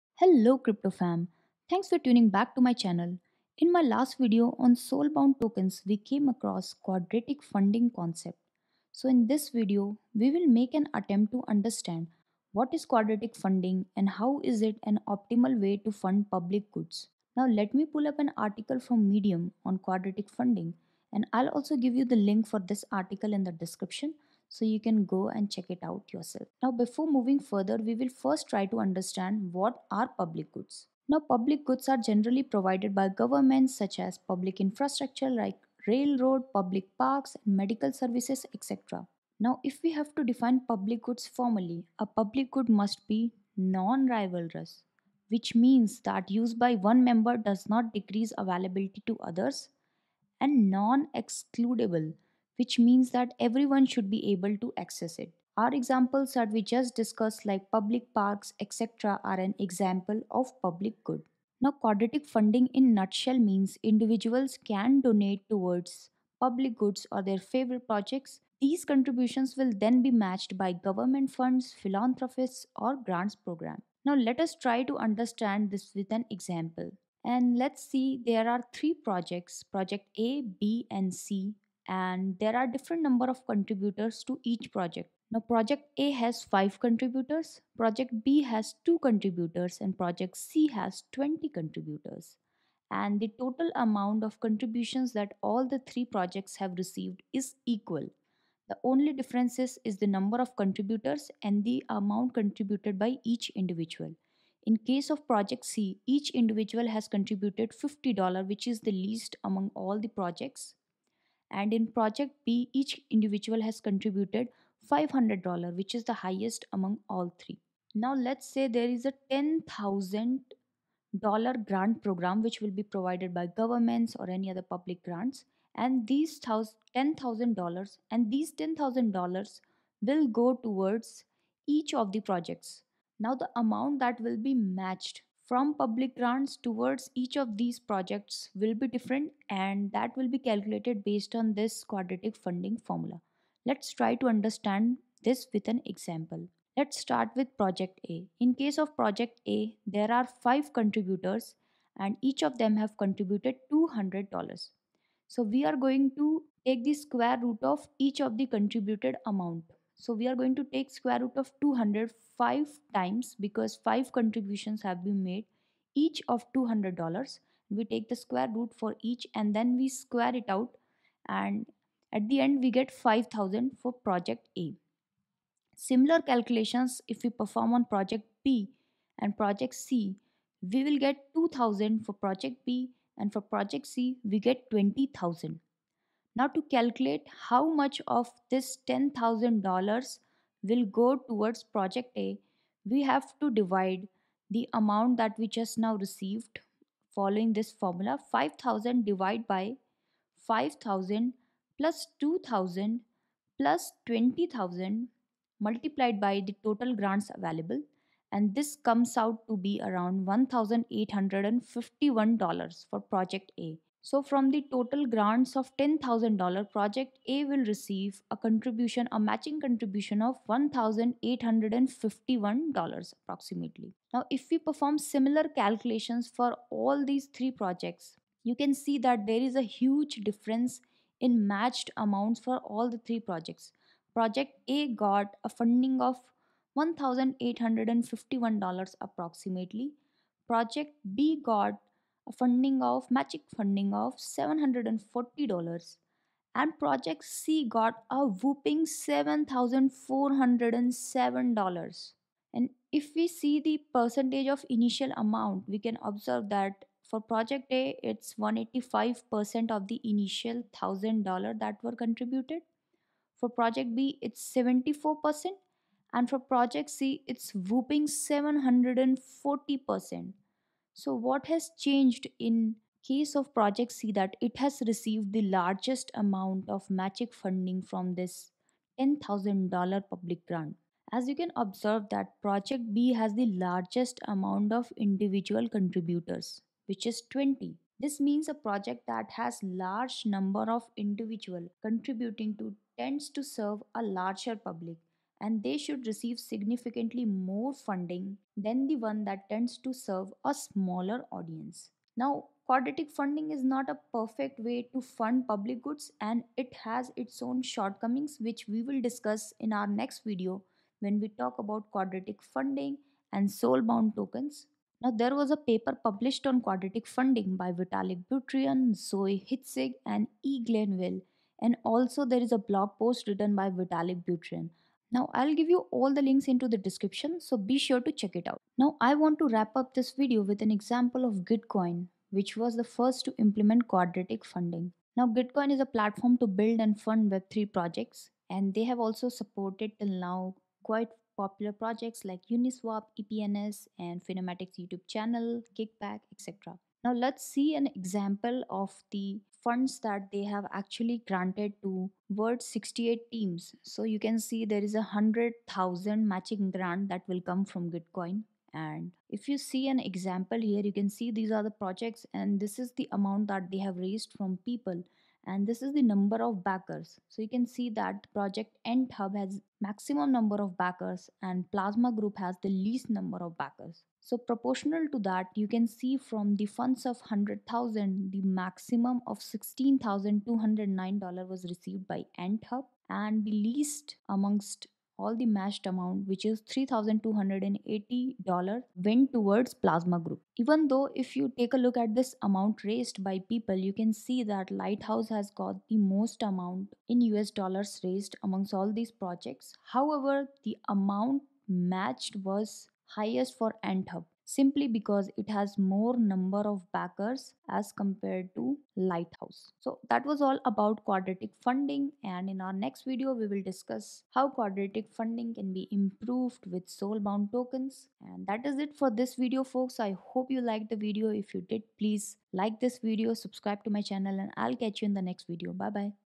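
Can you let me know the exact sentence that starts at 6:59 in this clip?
I hope you liked the video.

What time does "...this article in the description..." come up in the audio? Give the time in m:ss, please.
0:22.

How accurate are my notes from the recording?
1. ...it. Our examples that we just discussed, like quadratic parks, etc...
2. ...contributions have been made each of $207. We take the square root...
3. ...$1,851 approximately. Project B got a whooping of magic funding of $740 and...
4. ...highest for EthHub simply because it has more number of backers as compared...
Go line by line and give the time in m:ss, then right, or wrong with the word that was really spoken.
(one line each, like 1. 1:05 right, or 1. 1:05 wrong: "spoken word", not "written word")
1. 0:55 wrong: "public", not "quadratic"
2. 2:44 wrong: "200", not "207"
3. 3:56 wrong: "funding", not "whooping"
4. 6:43 right.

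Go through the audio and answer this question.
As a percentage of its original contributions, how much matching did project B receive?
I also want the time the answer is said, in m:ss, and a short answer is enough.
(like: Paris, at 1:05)
74%, at 4:24.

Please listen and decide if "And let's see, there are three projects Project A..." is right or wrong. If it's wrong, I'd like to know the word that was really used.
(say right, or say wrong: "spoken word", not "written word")
right.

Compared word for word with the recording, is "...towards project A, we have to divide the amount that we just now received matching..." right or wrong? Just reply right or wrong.
wrong.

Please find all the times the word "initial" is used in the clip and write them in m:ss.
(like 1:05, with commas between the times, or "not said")
4:14, 4:20.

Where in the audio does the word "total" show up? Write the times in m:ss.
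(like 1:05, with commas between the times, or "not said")
1:33, 3:26, 3:34.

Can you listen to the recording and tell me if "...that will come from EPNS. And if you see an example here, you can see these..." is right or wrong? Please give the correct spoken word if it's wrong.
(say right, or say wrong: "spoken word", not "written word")
wrong: "Gitcoin", not "EPNS".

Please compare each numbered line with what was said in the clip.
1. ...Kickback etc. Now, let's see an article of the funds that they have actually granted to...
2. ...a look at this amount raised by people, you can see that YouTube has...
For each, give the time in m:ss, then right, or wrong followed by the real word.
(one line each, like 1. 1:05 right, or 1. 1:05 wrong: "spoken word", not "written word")
1. 5:45 wrong: "example", not "article"
2. 6:31 wrong: "Lighthouse", not "YouTube".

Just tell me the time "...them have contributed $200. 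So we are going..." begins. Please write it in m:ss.
2:32.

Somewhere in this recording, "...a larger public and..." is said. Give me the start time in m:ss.
4:53.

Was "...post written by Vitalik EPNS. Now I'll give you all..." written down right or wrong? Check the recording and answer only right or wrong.
wrong.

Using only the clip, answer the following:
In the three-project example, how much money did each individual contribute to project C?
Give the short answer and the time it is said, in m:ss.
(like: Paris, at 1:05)
$50, at 1:47.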